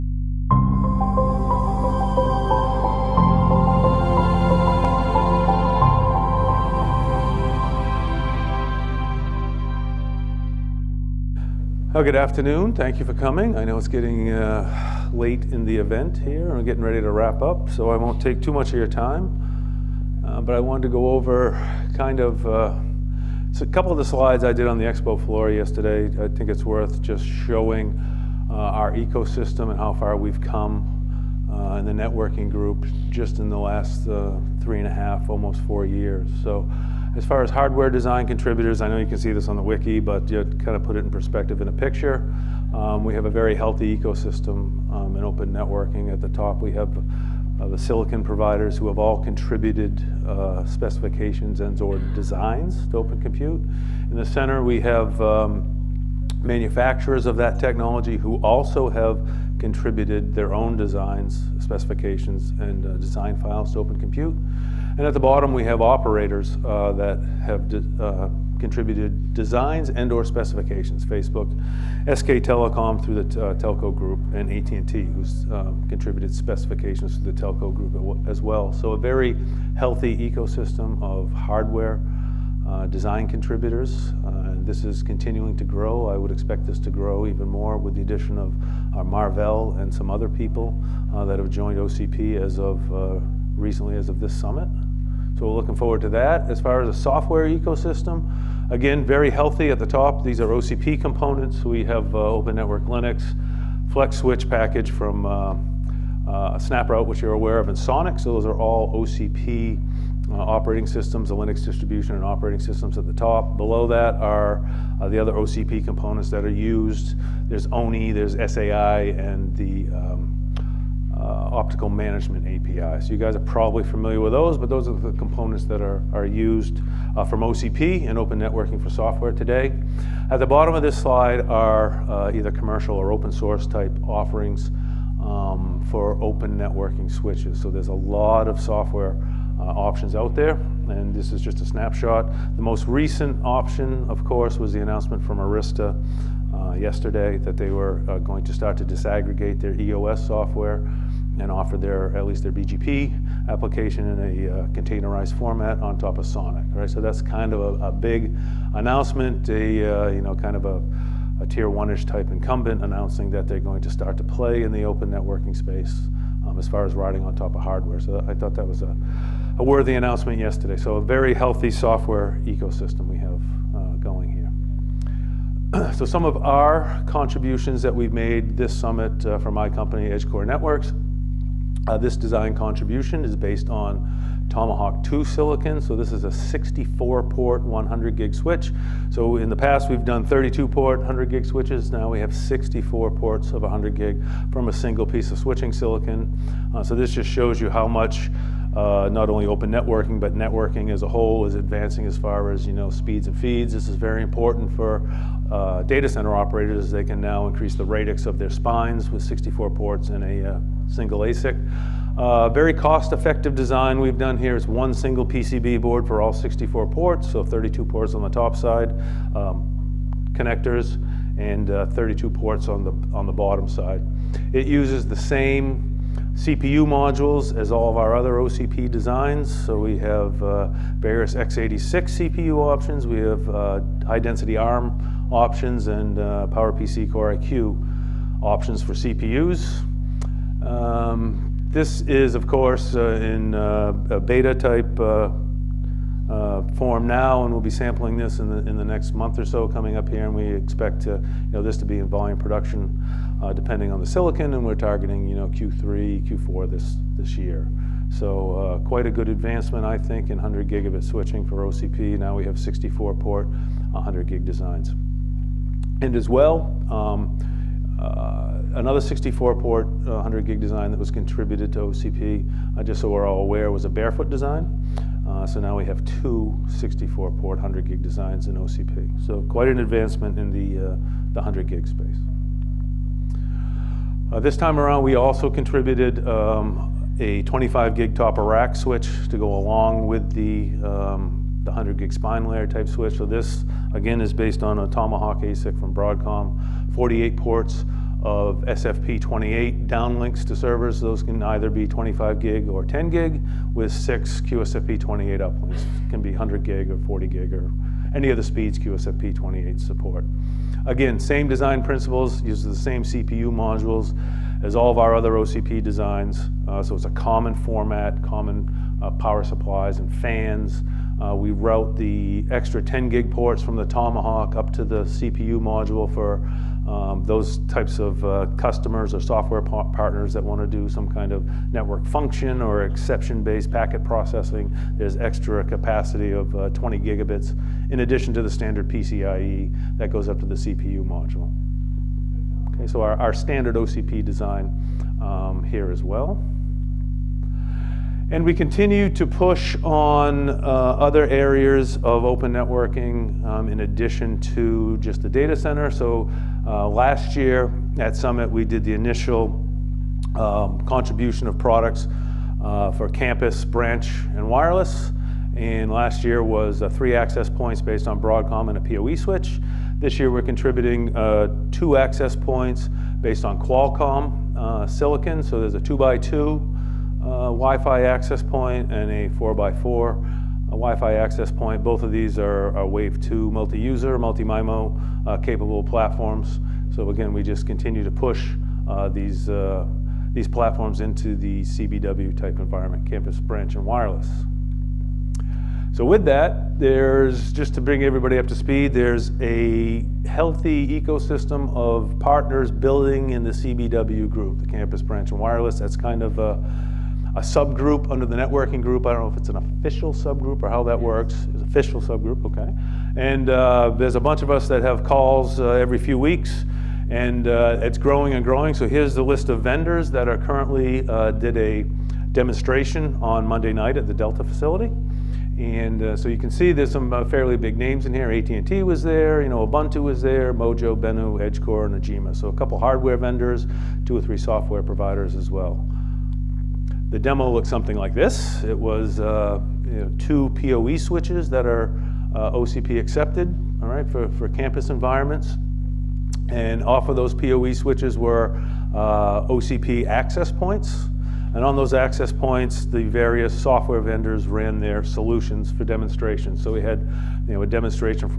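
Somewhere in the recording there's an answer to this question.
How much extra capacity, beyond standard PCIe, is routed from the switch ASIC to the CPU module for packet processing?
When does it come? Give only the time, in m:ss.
5:36.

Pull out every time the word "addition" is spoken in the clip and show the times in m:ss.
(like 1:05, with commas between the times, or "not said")
1:28, 5:38, 5:53.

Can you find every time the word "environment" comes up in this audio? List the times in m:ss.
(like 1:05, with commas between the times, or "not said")
6:32, 7:24.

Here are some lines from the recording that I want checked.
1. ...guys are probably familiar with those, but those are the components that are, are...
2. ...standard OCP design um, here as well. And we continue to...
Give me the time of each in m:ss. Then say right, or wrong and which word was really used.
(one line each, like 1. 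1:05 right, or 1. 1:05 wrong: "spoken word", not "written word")
1. 2:03 right
2. 5:43 right.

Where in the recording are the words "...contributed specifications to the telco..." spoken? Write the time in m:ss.
1:15.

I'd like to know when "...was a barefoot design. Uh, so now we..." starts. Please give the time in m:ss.
4:33.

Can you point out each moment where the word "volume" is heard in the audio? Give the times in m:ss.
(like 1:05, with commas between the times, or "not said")
4:12.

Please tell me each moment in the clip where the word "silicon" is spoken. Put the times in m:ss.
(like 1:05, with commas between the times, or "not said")
0:47, 3:05, 3:15, 4:14, 6:14.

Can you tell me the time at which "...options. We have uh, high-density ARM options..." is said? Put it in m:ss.
3:52.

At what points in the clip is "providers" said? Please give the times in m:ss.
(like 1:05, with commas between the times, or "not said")
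0:48, 7:14.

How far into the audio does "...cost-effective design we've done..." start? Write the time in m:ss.
3:32.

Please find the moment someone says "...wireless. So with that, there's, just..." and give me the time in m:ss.
6:33.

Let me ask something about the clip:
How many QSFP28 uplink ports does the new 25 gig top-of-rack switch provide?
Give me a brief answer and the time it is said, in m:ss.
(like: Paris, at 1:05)
6, at 5:03.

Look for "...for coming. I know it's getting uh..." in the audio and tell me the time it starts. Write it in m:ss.
0:13.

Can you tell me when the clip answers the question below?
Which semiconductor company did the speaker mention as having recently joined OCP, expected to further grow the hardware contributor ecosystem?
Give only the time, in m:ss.
1:29.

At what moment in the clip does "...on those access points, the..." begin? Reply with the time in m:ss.
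7:31.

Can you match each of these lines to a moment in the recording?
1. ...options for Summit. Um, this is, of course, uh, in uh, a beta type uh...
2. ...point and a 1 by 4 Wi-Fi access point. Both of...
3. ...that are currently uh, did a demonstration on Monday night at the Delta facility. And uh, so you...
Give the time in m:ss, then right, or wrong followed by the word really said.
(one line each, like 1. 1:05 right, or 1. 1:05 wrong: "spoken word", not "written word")
1. 3:58 wrong: "CPUs", not "Summit"
2. 6:18 wrong: "4", not "1"
3. 7:00 right.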